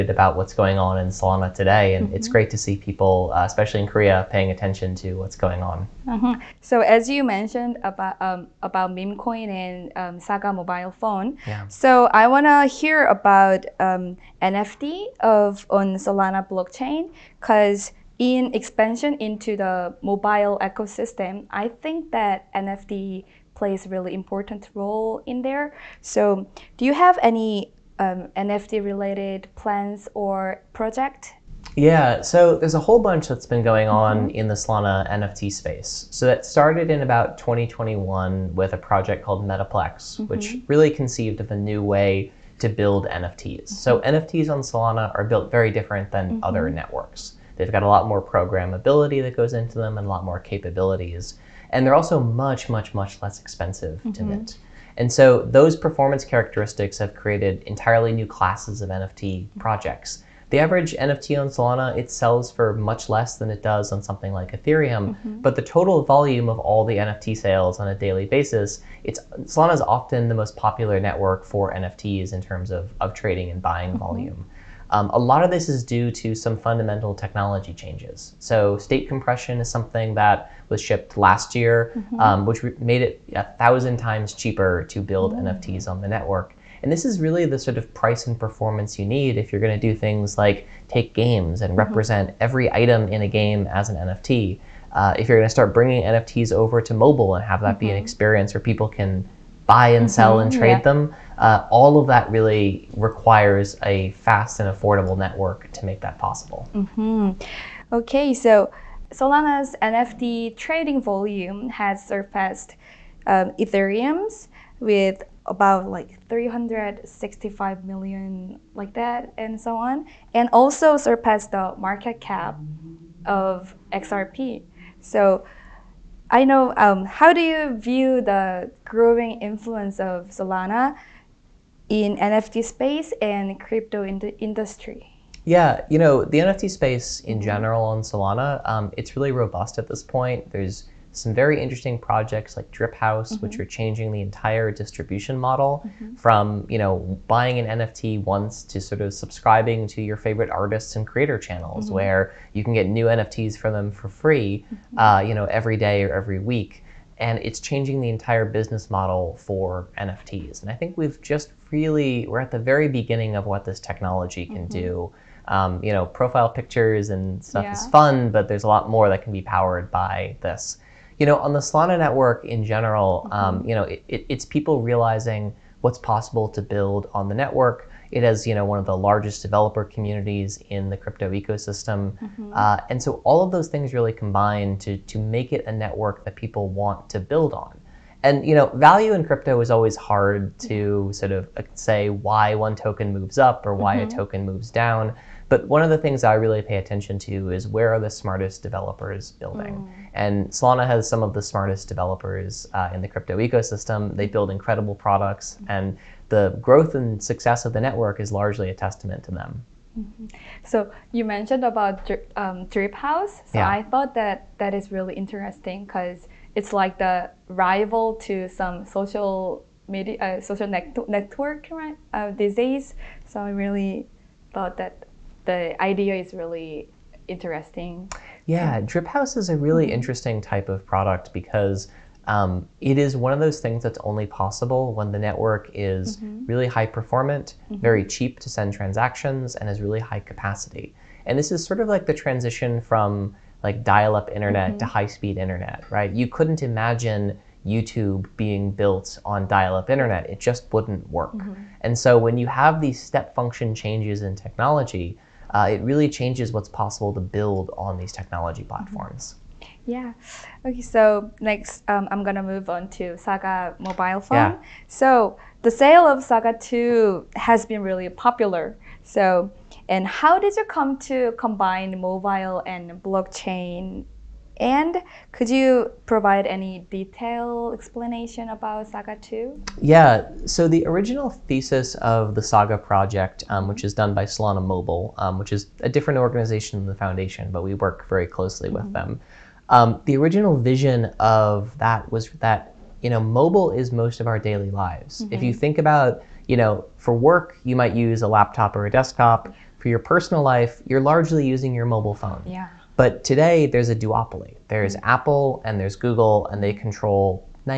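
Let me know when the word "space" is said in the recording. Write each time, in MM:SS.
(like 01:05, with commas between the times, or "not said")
00:35, 02:12, 02:16.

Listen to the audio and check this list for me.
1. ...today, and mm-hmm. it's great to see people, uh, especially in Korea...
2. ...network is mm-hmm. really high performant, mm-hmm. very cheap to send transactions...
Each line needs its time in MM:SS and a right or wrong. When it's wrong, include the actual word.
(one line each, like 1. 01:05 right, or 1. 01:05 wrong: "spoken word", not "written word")
1. 00:01 right
2. 03:55 right.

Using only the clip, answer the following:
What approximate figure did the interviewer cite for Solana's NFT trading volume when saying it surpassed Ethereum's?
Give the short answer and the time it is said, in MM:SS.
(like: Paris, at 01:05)
365 million, at 01:56.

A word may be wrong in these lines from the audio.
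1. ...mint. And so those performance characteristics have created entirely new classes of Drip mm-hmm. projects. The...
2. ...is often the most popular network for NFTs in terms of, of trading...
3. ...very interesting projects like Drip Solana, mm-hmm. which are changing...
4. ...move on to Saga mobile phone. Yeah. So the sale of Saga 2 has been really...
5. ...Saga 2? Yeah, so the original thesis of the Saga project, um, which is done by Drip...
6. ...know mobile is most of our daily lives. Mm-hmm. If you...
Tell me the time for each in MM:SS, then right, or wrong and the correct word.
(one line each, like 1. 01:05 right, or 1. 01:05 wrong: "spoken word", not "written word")
1. 00:54 wrong: "NFT", not "Drip"
2. 01:09 right
3. 02:21 wrong: "House", not "Solana"
4. 04:22 right
5. 04:38 wrong: "Solana", not "Drip"
6. 04:53 right.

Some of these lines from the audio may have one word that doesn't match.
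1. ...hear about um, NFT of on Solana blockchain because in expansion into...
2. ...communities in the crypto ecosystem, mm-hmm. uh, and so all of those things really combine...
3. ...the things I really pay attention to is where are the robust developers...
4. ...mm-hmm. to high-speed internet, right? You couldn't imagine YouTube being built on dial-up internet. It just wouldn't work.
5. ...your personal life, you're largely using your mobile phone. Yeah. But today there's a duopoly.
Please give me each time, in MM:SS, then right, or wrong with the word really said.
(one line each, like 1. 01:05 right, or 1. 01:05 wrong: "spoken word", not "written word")
1. 00:12 right
2. 02:59 right
3. 03:15 wrong: "smartest", not "robust"
4. 04:04 right
5. 04:59 right.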